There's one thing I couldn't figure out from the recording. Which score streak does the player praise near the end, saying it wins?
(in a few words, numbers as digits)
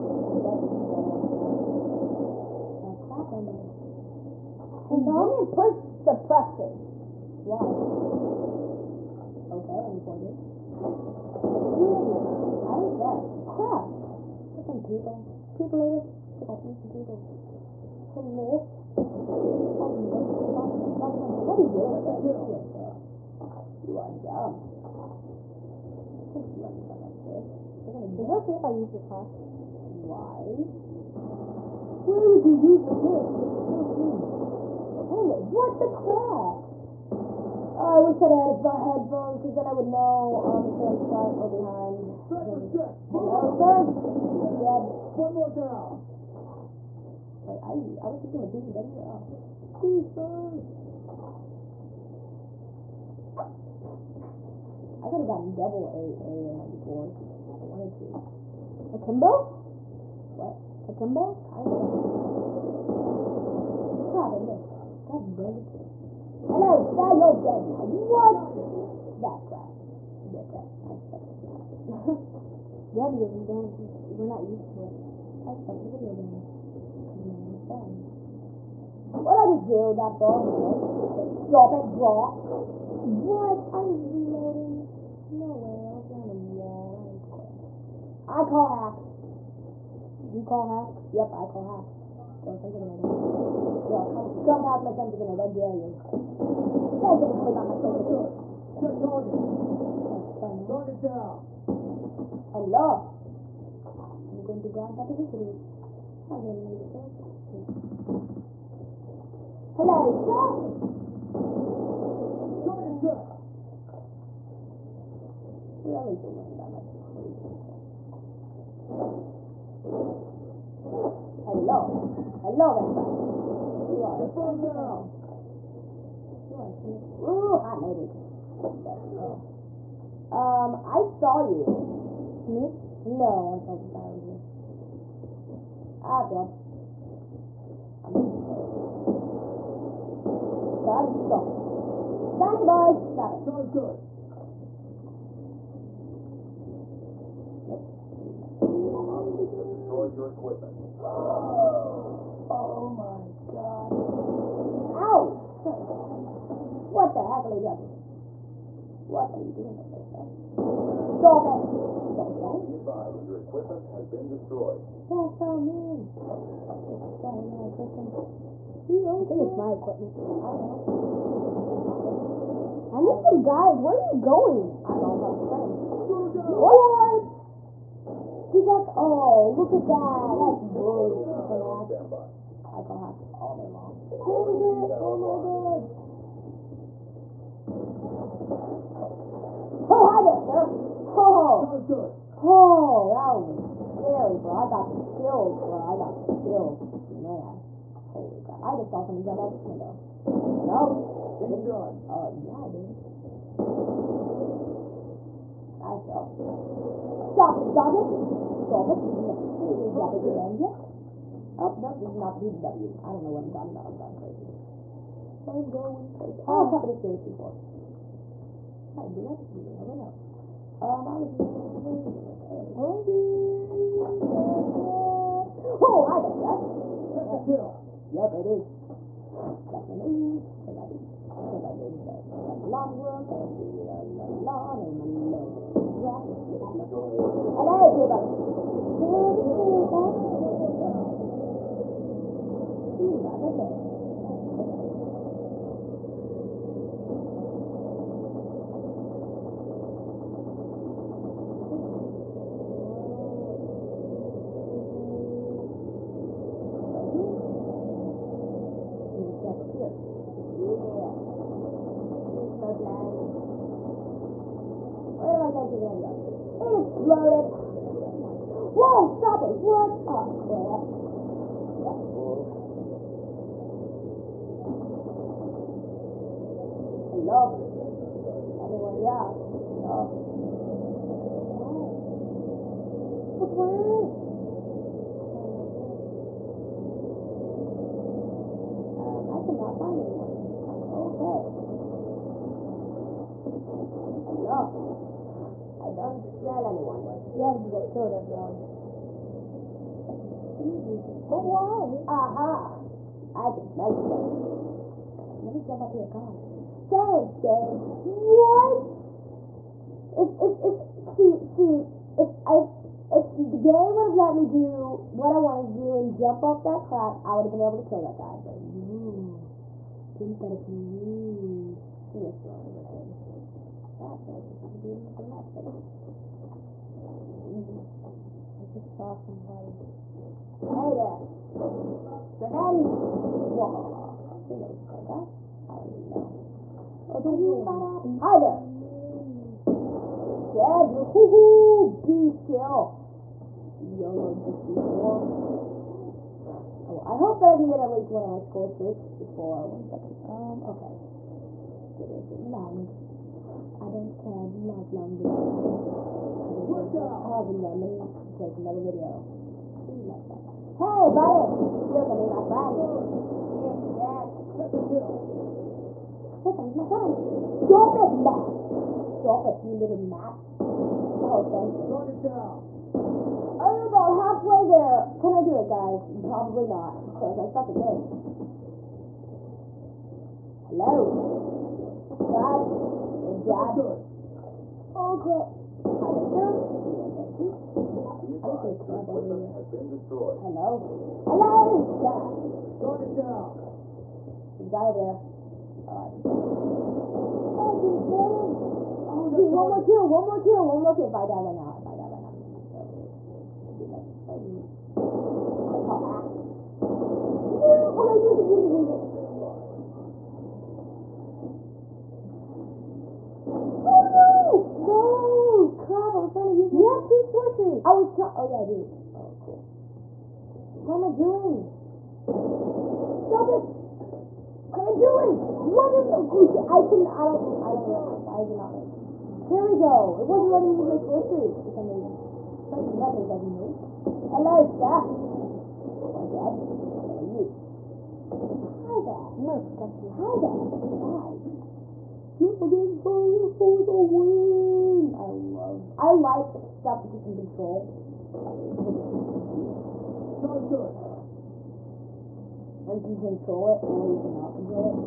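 Dragonfire.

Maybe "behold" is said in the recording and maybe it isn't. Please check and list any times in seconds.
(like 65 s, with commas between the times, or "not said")
not said.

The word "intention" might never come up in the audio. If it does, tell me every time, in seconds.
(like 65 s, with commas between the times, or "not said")
not said.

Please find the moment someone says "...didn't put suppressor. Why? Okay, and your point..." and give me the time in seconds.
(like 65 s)
5 s.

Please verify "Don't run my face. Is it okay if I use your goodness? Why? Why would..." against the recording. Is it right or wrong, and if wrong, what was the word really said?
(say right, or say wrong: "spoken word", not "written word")
wrong: "class", not "goodness".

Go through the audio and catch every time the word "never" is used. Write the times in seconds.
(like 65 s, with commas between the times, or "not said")
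219 s.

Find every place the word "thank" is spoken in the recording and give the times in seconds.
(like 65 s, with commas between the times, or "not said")
96 s, 306 s, 371 s.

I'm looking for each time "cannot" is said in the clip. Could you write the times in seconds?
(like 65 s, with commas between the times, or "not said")
454 s.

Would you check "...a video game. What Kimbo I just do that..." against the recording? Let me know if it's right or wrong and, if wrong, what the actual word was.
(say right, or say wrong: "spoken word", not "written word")
wrong: "What", not "Kimbo".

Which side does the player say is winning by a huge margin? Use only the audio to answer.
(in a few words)
Rallies.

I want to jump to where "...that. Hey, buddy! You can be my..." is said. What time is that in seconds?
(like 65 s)
360 s.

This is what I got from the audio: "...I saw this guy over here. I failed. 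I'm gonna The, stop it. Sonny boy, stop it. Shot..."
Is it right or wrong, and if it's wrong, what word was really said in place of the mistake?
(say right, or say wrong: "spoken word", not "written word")
wrong: "Son", not "The".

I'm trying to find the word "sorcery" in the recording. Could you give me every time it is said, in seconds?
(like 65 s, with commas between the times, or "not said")
417 s.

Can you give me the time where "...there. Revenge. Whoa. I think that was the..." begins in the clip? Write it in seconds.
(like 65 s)
331 s.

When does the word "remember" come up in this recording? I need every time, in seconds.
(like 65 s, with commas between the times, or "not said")
427 s.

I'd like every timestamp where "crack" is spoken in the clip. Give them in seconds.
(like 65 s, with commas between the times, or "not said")
316 s.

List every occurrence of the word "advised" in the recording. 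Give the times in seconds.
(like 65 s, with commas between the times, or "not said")
162 s.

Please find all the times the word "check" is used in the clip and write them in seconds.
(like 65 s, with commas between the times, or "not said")
98 s, 112 s.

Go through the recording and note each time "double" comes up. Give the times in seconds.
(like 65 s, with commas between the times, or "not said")
55 s.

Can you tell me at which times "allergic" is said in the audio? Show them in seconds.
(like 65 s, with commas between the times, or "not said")
235 s.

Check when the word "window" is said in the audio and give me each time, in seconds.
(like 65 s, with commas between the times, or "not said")
199 s.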